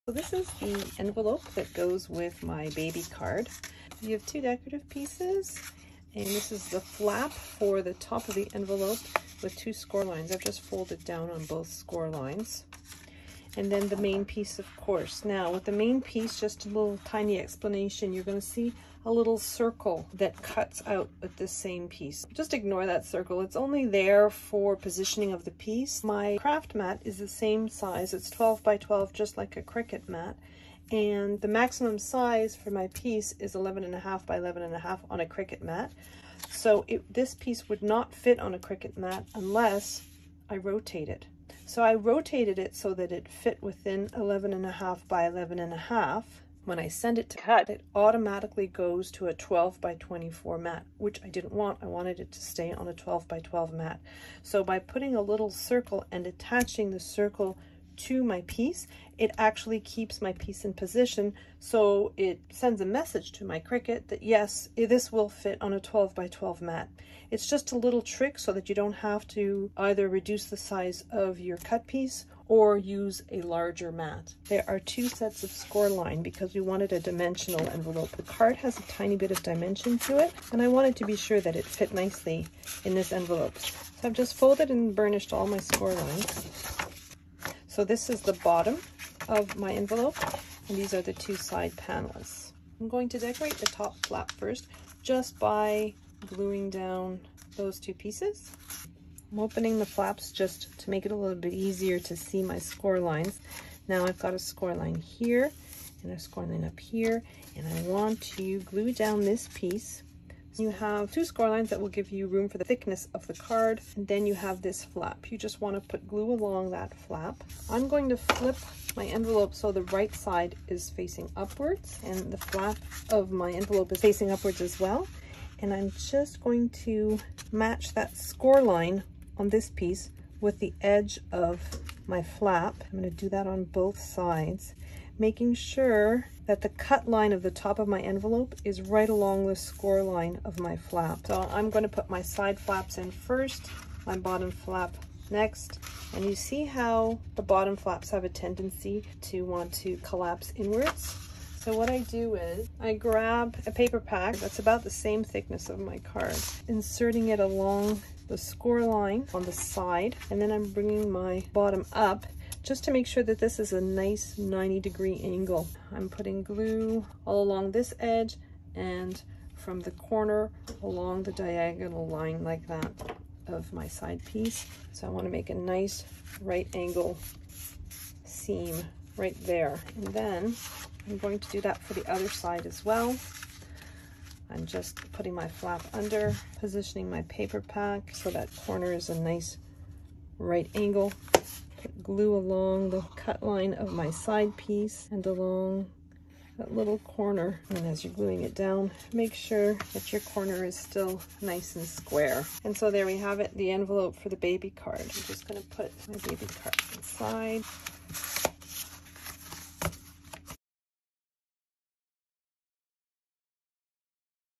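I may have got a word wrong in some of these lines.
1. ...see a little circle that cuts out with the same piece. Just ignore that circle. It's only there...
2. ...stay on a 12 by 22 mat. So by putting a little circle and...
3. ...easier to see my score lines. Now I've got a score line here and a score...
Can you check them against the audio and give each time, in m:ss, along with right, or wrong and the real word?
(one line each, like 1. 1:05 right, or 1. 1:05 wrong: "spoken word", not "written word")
1. 0:18 right
2. 0:52 wrong: "12", not "22"
3. 1:41 right.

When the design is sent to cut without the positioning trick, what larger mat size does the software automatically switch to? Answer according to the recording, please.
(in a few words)
12 by 24.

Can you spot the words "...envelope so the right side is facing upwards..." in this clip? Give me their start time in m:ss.
1:59.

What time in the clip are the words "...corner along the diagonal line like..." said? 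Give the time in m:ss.
2:49.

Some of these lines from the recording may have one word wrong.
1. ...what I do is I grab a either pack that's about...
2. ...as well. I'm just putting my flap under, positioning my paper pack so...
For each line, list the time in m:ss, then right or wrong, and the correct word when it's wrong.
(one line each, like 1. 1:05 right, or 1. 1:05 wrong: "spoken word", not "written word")
1. 2:31 wrong: "paper", not "either"
2. 3:02 right.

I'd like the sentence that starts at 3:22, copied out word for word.
And so there we have it, the envelope for the baby card.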